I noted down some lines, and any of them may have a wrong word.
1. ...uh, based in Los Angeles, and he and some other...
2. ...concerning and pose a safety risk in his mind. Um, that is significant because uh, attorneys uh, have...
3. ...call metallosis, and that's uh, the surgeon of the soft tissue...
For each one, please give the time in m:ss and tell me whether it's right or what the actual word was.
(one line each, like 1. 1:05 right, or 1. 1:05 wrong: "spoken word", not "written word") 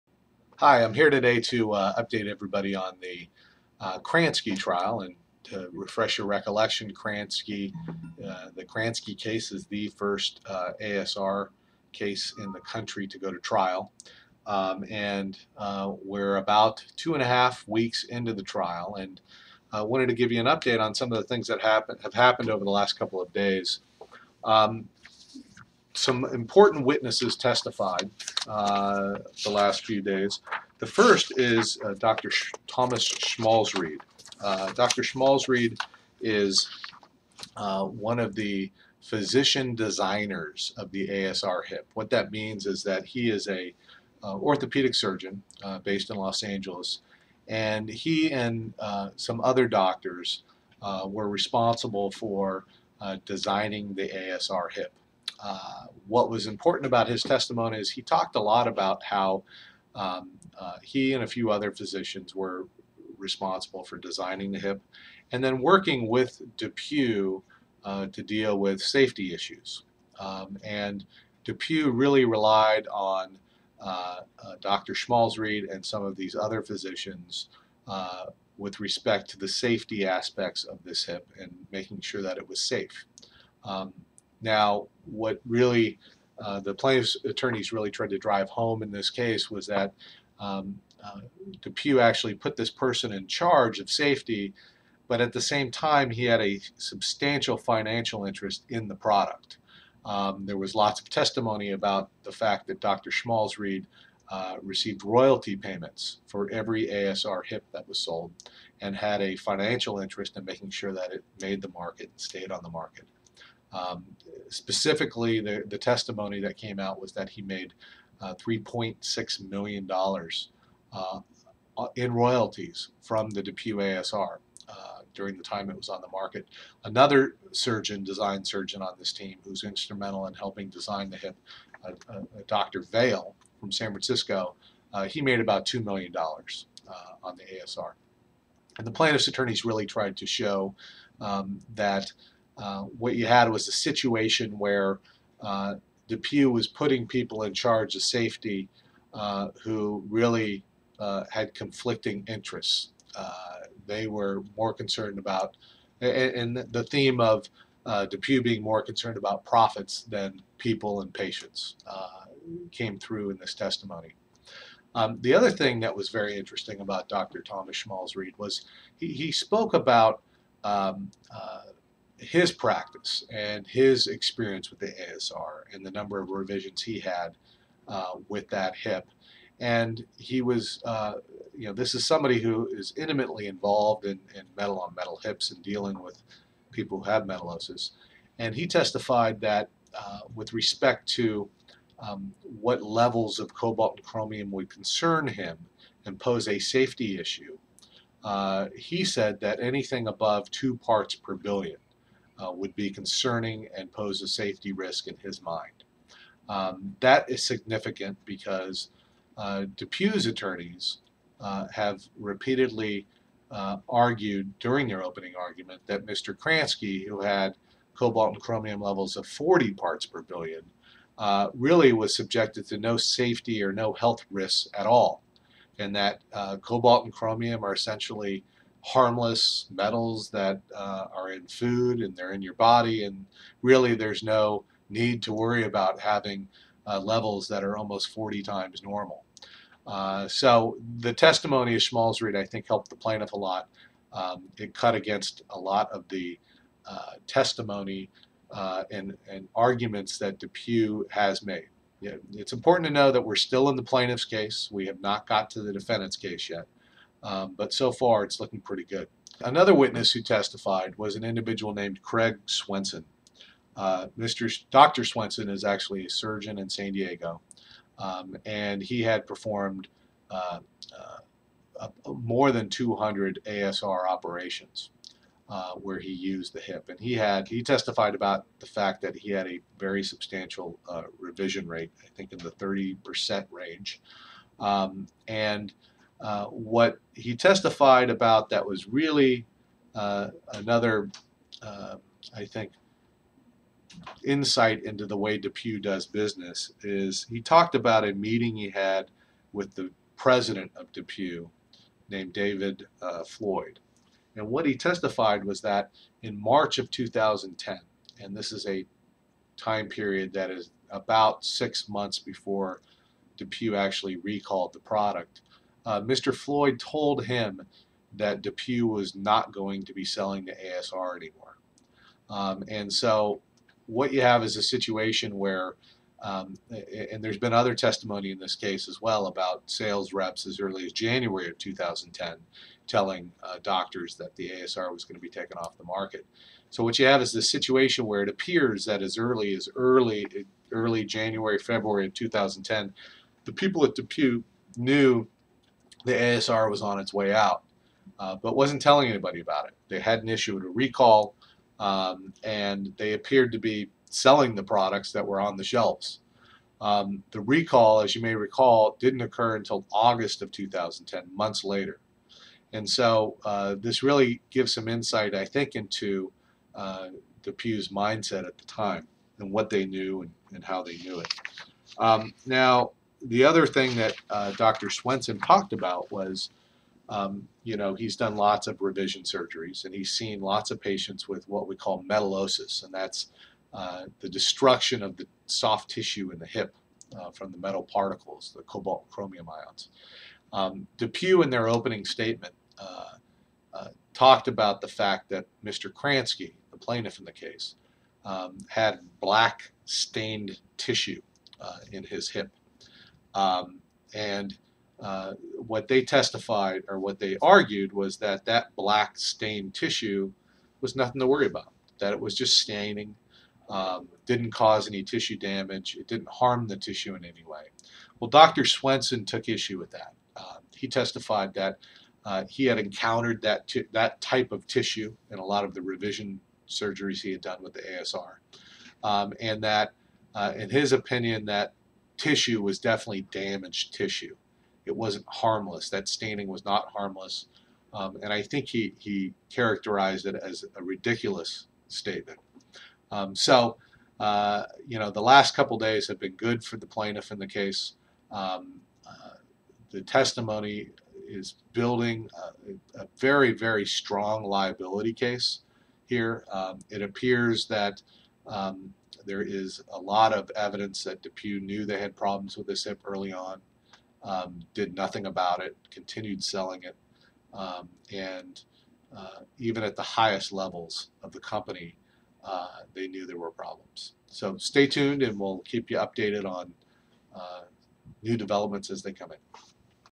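1. 0:45 right
2. 3:22 right
3. 6:21 wrong: "destruction", not "surgeon".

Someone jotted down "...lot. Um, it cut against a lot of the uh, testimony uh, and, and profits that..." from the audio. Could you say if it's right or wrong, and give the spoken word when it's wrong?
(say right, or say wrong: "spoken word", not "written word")
wrong: "arguments", not "profits".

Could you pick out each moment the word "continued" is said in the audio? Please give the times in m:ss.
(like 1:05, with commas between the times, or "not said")
7:45.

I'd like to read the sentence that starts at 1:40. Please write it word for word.
Um, there was lots of testimony about the fact that Dr.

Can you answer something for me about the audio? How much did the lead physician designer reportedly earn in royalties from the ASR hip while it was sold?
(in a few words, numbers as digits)
$3.6 million.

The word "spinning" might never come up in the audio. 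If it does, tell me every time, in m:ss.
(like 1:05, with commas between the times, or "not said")
not said.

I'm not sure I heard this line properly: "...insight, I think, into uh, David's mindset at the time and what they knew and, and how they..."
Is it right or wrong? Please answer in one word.
wrong.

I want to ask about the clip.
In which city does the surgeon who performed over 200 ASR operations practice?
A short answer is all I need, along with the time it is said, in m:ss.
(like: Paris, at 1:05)
San Diego, at 4:26.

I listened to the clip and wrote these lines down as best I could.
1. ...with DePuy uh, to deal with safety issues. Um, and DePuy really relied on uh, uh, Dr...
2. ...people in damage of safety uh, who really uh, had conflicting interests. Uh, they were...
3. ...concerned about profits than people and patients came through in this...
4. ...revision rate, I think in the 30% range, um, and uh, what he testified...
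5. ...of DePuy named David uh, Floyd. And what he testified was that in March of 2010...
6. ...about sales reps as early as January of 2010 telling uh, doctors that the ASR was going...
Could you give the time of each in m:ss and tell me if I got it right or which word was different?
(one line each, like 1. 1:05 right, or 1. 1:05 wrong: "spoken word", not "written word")
1. 1:06 right
2. 2:27 wrong: "charge", not "damage"
3. 2:38 right
4. 4:41 right
5. 5:00 right
6. 5:29 right.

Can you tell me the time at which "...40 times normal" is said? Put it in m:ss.
3:58.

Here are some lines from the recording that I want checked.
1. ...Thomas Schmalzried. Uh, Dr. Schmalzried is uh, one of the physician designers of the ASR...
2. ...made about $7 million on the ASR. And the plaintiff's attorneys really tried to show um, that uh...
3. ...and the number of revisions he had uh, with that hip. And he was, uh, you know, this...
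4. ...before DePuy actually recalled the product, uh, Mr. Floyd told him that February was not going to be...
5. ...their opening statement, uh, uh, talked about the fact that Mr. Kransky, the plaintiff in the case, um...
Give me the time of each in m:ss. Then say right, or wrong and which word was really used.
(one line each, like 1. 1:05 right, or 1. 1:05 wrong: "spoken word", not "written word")
1. 0:32 right
2. 2:15 wrong: "2", not "7"
3. 2:55 right
4. 5:12 wrong: "DePuy", not "February"
5. 6:31 right.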